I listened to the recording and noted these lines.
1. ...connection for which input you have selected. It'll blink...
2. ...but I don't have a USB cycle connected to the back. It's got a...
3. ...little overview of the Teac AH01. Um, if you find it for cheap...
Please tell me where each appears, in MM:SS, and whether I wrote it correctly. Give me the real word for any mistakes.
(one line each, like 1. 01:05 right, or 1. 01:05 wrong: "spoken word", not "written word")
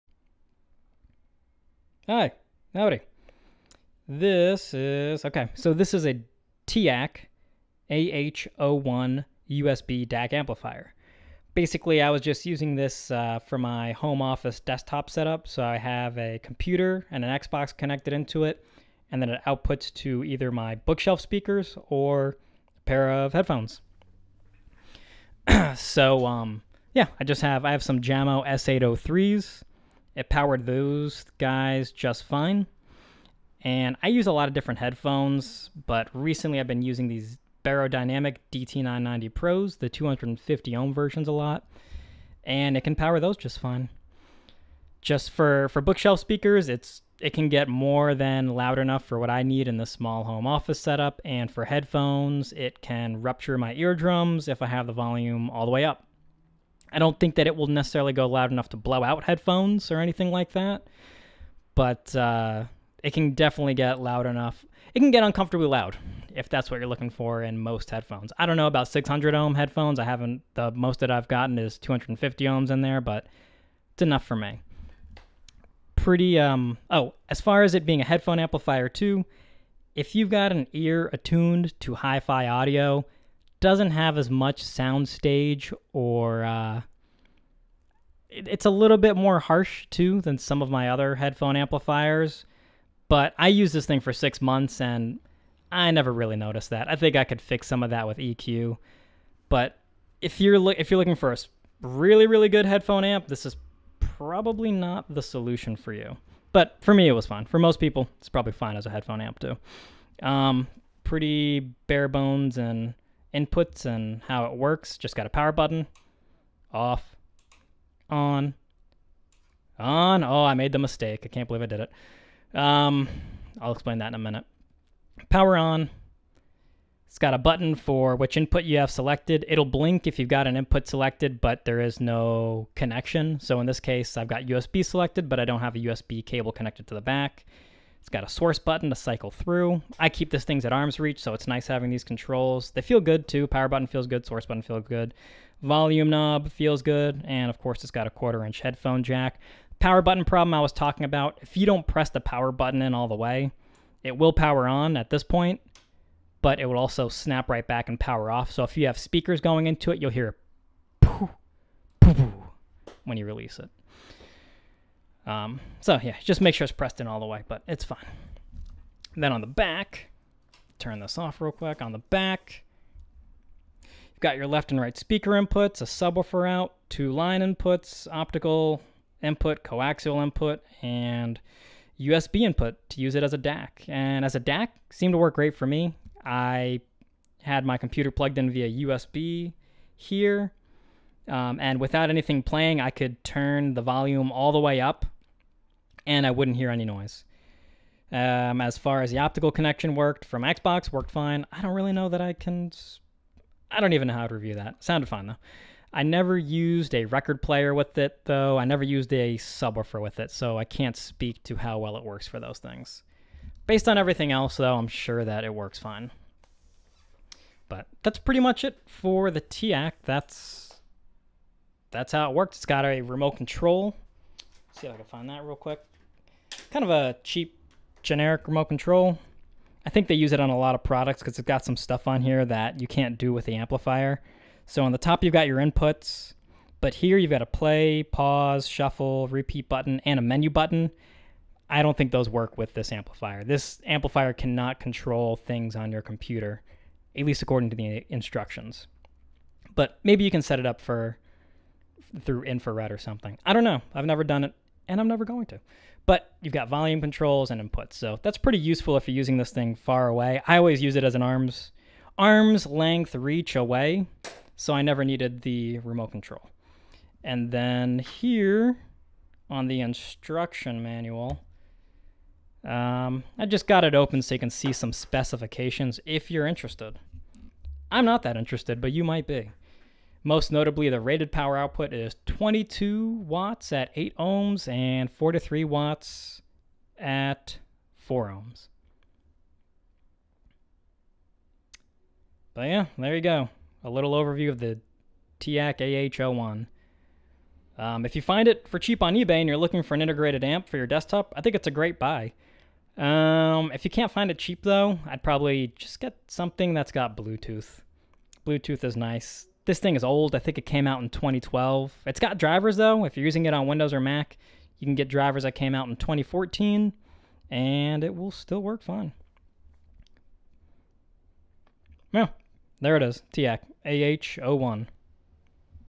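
1. 02:07 wrong: "button", not "connection"
2. 02:15 wrong: "cable", not "cycle"
3. 04:53 right.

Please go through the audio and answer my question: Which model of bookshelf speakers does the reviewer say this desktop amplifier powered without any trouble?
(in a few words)
Jamo S803.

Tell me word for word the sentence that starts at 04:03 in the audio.
This amplifier cannot control things on your computer, at least according to the instructions.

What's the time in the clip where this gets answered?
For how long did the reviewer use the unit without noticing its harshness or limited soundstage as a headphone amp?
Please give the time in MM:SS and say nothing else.
01:34.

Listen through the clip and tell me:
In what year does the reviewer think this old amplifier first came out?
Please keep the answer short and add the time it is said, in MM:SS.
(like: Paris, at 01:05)
2012, at 05:11.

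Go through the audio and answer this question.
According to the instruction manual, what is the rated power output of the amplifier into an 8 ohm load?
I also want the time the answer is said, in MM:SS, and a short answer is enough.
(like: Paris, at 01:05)
22 watts, at 04:42.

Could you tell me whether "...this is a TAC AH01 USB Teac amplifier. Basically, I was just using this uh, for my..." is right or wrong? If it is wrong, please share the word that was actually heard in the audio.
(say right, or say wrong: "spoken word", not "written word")
wrong: "DAC", not "Teac".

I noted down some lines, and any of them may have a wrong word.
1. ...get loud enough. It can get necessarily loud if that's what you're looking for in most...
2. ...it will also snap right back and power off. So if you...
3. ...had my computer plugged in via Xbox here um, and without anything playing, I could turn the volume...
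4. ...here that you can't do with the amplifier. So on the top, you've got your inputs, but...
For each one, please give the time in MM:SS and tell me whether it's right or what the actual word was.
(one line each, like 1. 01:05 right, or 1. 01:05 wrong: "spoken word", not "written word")
1. 01:03 wrong: "uncomfortably", not "necessarily"
2. 02:36 right
3. 03:07 wrong: "USB", not "Xbox"
4. 03:52 right.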